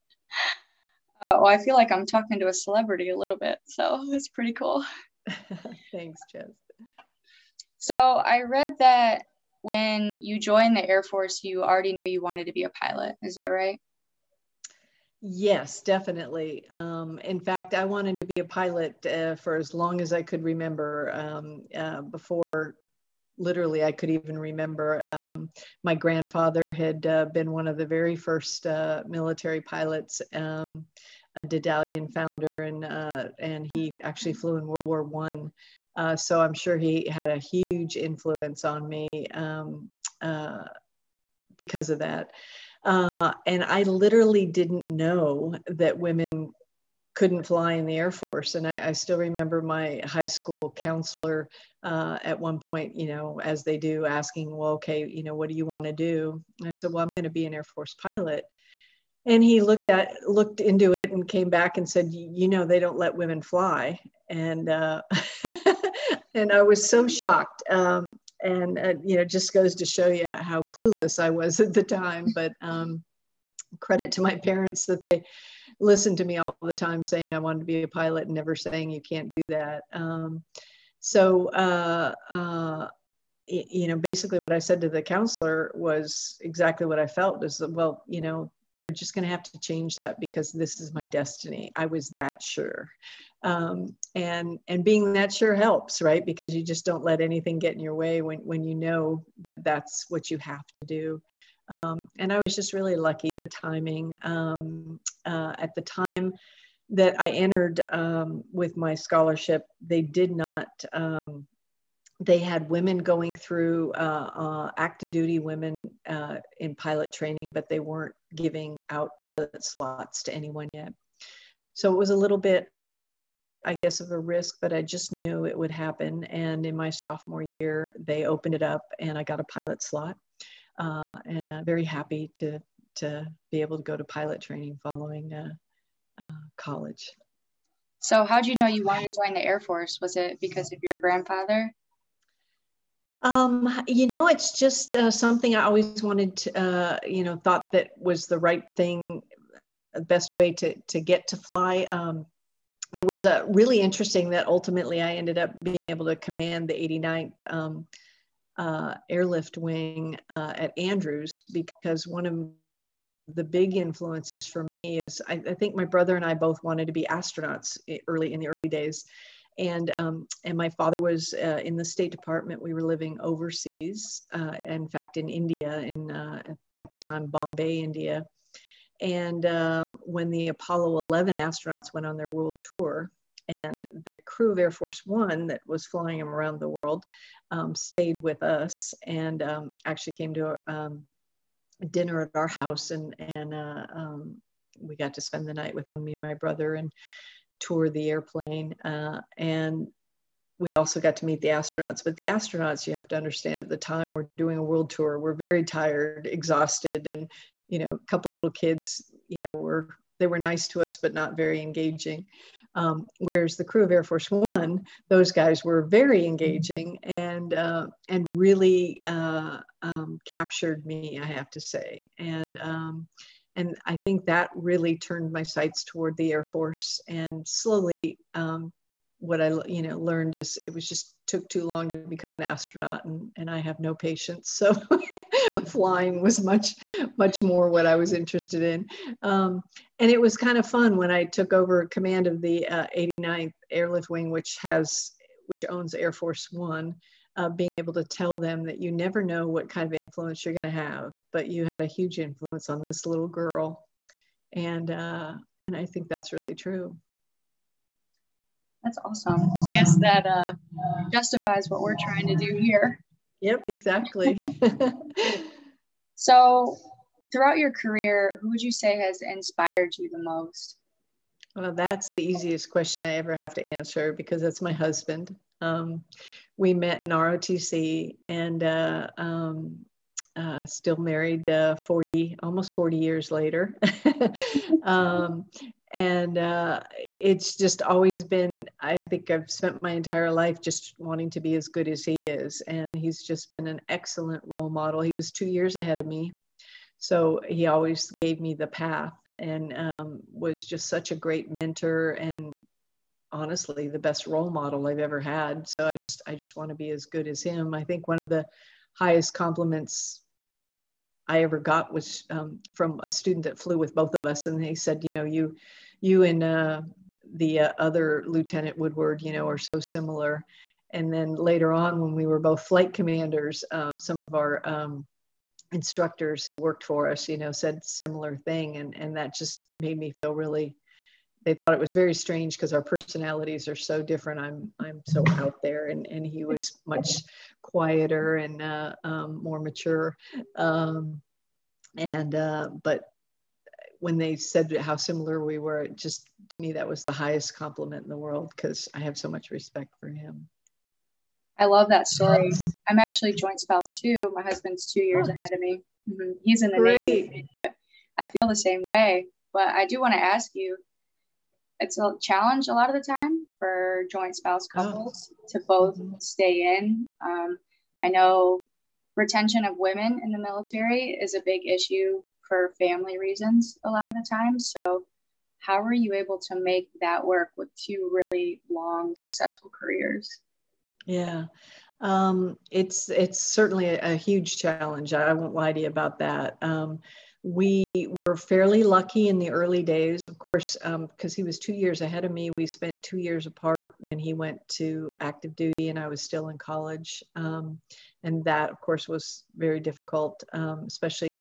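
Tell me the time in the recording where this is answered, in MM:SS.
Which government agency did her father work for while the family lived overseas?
02:51.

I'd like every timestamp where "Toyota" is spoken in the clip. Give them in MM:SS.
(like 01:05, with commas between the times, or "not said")
not said.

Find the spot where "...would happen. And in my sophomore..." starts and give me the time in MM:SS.
02:05.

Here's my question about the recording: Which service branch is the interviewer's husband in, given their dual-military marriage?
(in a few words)
Navy.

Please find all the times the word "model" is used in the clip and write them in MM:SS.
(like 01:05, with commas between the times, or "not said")
04:54, 05:04.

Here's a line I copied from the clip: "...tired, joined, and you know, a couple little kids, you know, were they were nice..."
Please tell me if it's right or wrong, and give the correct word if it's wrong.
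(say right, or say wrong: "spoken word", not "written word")
wrong: "exhausted", not "joined".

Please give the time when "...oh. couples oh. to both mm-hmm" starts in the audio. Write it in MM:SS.
06:04.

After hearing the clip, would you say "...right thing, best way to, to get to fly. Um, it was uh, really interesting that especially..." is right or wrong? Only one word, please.
wrong.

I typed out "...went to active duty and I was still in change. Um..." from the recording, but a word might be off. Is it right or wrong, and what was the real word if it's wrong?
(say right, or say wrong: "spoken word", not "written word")
wrong: "college", not "change".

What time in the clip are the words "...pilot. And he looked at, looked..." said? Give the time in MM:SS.
00:58.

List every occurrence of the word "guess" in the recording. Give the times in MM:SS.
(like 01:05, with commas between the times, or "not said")
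02:03, 04:19.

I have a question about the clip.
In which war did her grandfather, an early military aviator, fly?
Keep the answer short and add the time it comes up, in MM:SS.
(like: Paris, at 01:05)
World War One, at 00:34.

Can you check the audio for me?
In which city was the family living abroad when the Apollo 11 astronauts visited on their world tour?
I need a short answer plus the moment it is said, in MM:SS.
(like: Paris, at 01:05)
Bombay, at 02:57.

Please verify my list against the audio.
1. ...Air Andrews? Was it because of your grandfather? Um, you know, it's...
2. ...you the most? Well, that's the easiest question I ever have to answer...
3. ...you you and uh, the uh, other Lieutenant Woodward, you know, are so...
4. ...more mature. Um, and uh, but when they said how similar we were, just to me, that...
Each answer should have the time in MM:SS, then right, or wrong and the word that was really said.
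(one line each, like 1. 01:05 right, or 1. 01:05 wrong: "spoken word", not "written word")
1. 02:19 wrong: "Force", not "Andrews"
2. 04:29 right
3. 05:15 right
4. 05:39 right.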